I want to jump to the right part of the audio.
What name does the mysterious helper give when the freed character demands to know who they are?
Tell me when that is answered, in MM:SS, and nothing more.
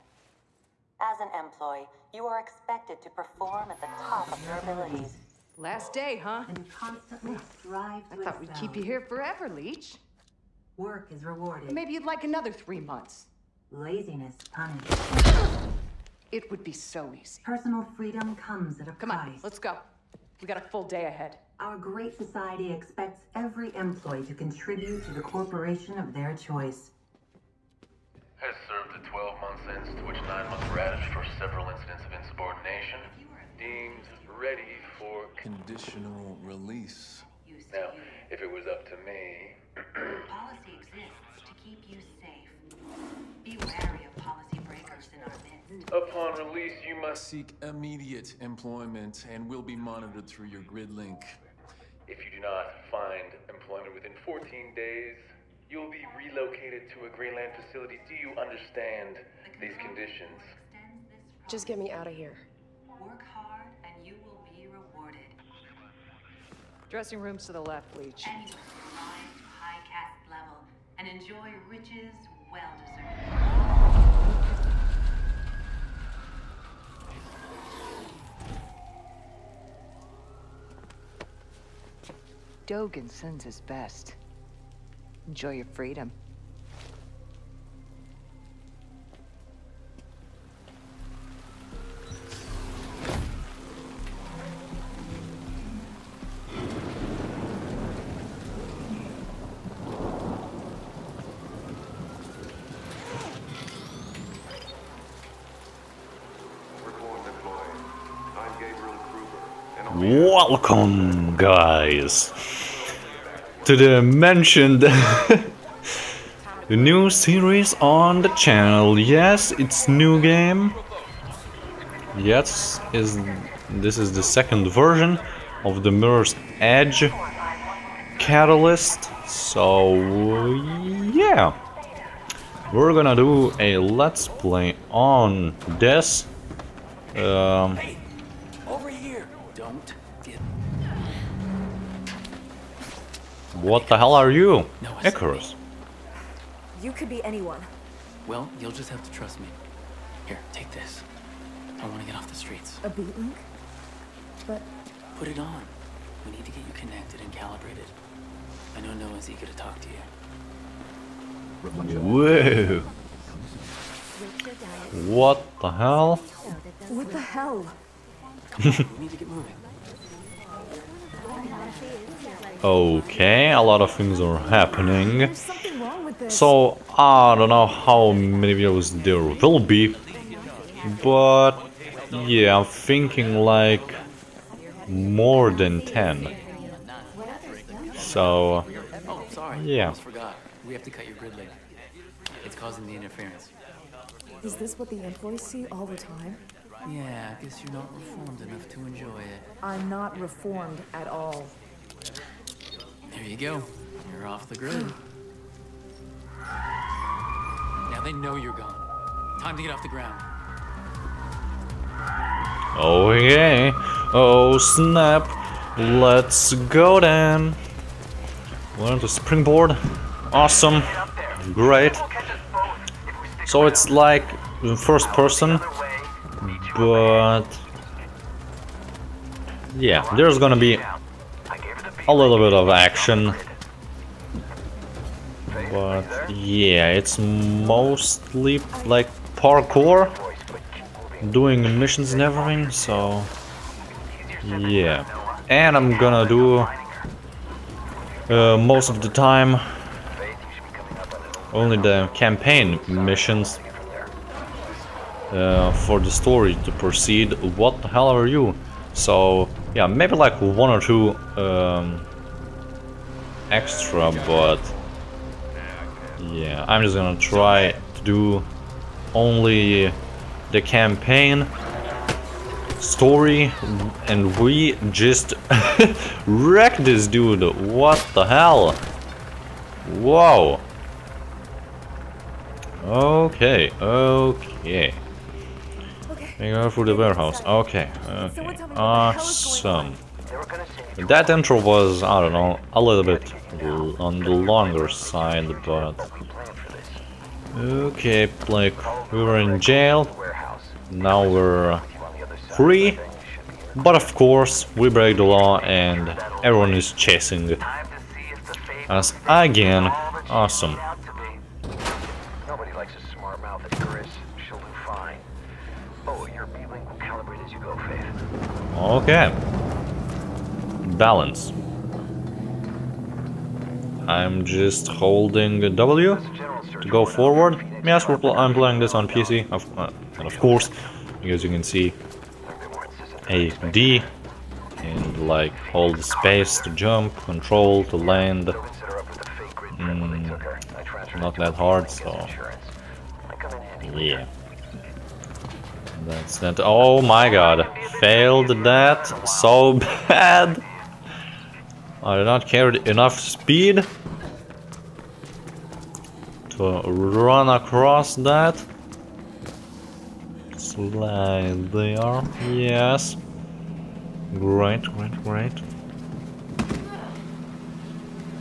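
02:25.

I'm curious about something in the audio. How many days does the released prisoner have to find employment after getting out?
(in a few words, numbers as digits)
14.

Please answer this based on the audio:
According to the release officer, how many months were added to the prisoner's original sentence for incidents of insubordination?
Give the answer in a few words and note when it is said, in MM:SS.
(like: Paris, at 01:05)
9, at 00:30.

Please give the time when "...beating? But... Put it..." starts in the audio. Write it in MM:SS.
02:32.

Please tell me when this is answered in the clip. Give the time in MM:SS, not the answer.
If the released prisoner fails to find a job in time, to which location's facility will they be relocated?
00:57.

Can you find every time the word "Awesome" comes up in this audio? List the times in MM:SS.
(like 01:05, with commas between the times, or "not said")
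03:40, 04:48, 05:10.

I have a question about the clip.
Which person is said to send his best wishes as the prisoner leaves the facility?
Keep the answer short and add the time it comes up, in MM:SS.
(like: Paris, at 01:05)
Dogen, at 01:22.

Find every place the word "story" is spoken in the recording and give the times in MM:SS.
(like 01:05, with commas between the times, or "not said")
04:16, 04:32.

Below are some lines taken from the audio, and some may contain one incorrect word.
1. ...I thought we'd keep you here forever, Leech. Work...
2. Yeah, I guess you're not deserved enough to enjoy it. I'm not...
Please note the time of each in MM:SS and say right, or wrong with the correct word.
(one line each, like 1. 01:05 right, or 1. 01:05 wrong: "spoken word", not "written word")
1. 00:08 right
2. 03:16 wrong: "reformed", not "deserved".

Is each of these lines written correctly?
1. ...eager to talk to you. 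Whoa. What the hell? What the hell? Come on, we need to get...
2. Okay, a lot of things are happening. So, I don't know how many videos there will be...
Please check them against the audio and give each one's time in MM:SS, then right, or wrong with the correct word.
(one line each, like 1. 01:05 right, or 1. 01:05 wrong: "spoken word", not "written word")
1. 02:39 right
2. 02:52 right.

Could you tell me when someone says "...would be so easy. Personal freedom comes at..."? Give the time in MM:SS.
00:16.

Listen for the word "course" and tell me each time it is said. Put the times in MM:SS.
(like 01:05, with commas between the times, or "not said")
05:04, 05:30.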